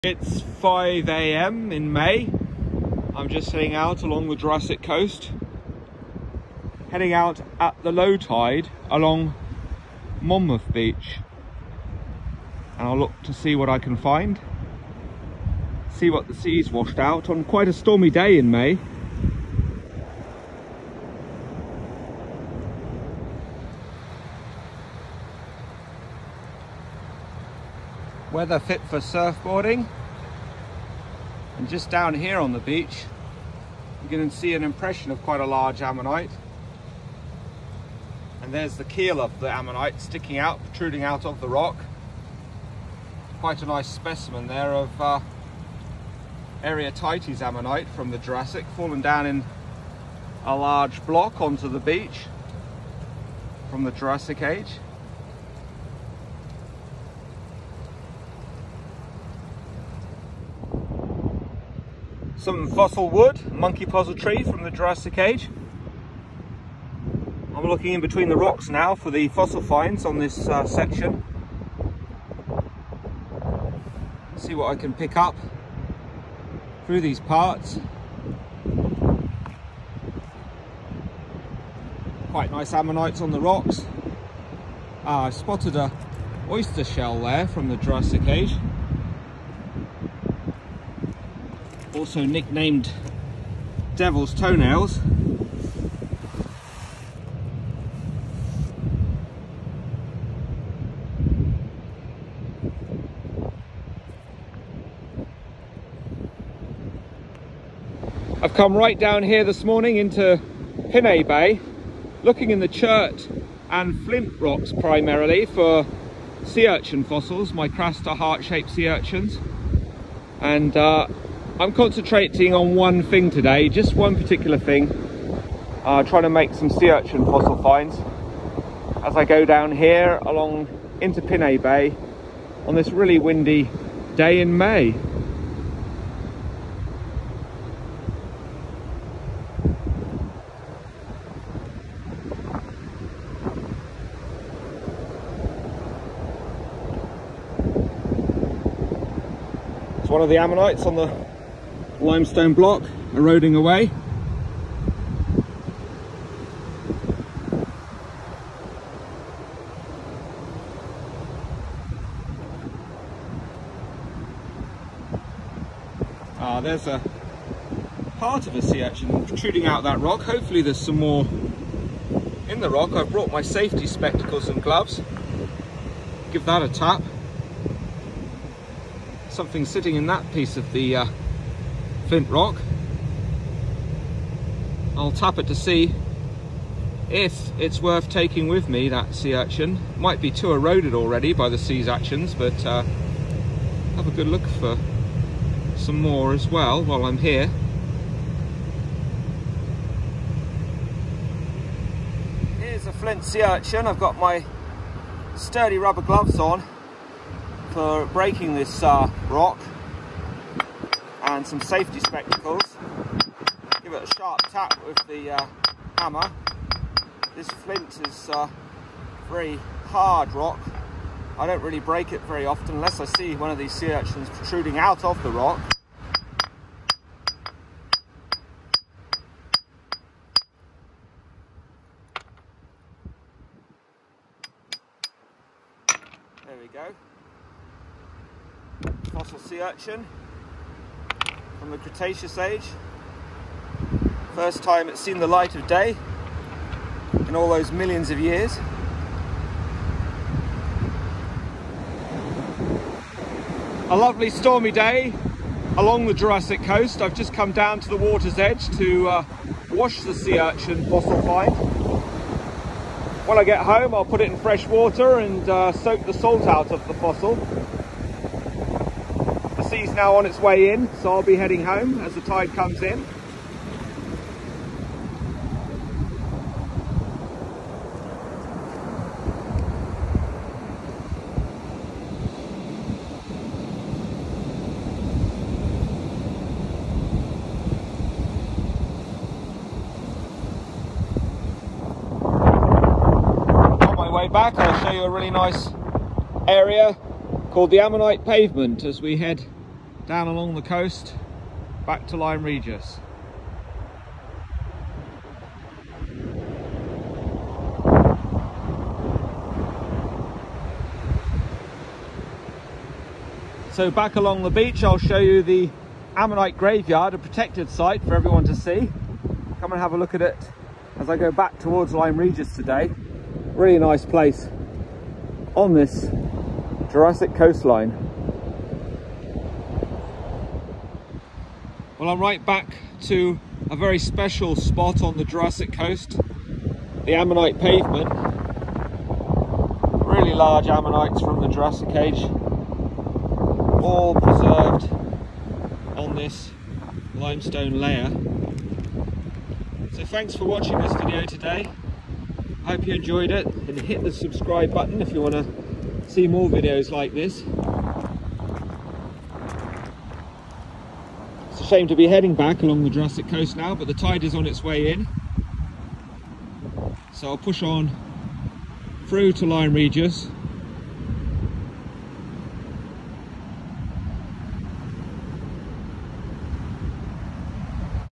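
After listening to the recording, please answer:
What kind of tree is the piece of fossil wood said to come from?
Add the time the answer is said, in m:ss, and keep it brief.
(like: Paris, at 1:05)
Monkey puzzle tree, at 1:03.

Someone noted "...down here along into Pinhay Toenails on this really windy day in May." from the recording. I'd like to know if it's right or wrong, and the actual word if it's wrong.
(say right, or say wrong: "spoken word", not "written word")
wrong: "Bay", not "Toenails".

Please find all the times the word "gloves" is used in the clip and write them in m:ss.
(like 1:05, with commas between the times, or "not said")
2:54, 3:26.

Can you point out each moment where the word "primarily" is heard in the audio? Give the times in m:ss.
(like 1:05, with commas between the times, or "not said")
1:54.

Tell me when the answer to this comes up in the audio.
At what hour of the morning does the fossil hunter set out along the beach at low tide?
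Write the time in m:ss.
0:00.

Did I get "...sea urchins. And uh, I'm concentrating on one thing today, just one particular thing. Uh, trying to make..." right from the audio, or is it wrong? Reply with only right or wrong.
right.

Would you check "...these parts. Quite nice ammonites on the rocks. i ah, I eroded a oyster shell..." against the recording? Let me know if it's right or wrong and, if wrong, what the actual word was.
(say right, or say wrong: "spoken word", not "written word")
wrong: "spotted", not "eroded".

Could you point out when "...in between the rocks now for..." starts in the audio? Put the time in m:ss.
1:07.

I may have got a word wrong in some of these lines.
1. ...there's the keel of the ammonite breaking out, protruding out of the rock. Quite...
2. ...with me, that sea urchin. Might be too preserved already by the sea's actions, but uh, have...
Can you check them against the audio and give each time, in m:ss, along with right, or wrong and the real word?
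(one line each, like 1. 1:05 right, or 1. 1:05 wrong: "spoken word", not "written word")
1. 0:38 wrong: "sticking", not "breaking"
2. 3:08 wrong: "eroded", not "preserved".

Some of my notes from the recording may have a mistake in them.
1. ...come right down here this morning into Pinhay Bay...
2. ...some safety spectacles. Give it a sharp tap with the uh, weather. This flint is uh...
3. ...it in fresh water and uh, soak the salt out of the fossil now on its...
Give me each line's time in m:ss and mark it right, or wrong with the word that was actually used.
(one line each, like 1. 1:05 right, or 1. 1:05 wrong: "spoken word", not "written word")
1. 1:48 right
2. 3:31 wrong: "hammer", not "weather"
3. 4:24 right.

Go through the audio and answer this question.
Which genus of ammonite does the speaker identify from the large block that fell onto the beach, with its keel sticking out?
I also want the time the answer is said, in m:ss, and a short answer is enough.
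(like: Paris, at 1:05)
Arietites, at 0:46.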